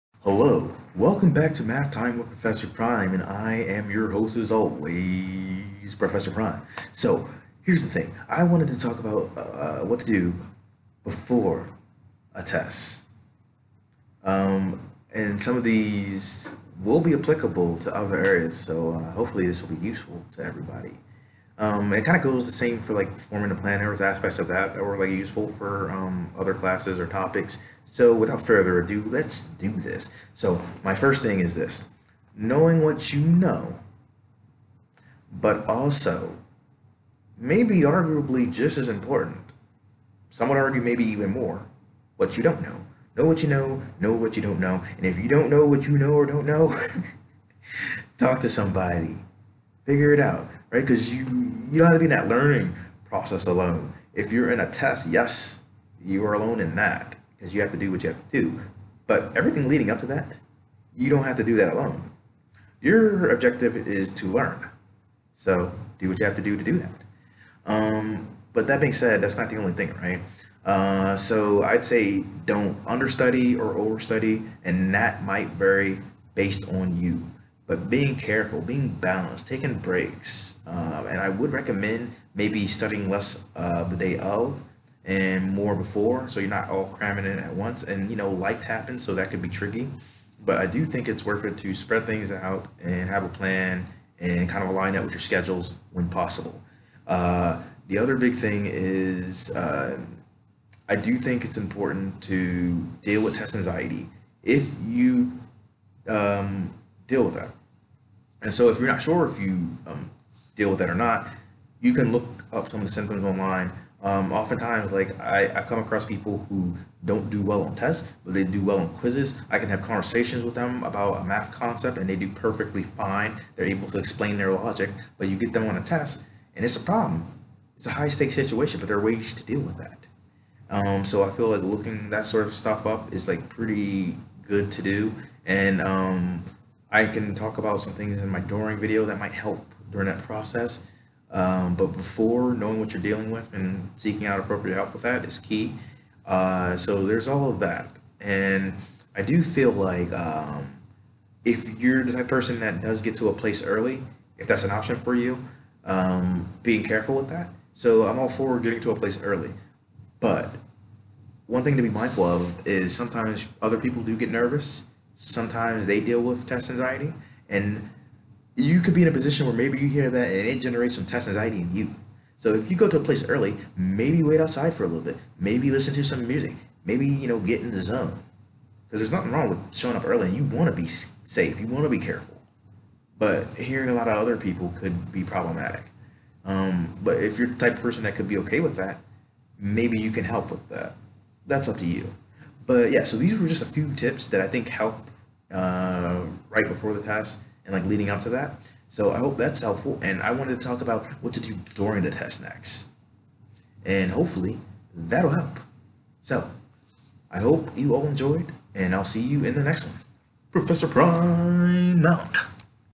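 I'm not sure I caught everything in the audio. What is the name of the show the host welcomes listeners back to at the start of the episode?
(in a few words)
Math Time with Professor Prime.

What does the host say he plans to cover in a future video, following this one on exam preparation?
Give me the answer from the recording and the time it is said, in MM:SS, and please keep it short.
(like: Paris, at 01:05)
what to do during the test, at 03:21.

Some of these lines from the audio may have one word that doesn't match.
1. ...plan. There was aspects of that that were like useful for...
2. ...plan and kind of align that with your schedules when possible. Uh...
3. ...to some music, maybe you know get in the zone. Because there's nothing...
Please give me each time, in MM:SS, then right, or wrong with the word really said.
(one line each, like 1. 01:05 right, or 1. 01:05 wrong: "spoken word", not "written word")
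1. 00:23 right
2. 01:33 right
3. 02:55 right.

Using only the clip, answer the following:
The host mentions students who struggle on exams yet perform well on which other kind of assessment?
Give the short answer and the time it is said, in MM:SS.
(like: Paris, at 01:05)
quizzes, at 01:58.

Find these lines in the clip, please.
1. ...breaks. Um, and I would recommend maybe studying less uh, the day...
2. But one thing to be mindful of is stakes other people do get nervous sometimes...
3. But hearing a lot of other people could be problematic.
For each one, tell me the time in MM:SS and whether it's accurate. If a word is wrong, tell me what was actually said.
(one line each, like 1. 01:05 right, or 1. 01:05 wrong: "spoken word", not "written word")
1. 01:19 right
2. 02:40 wrong: "sometimes", not "stakes"
3. 03:03 right.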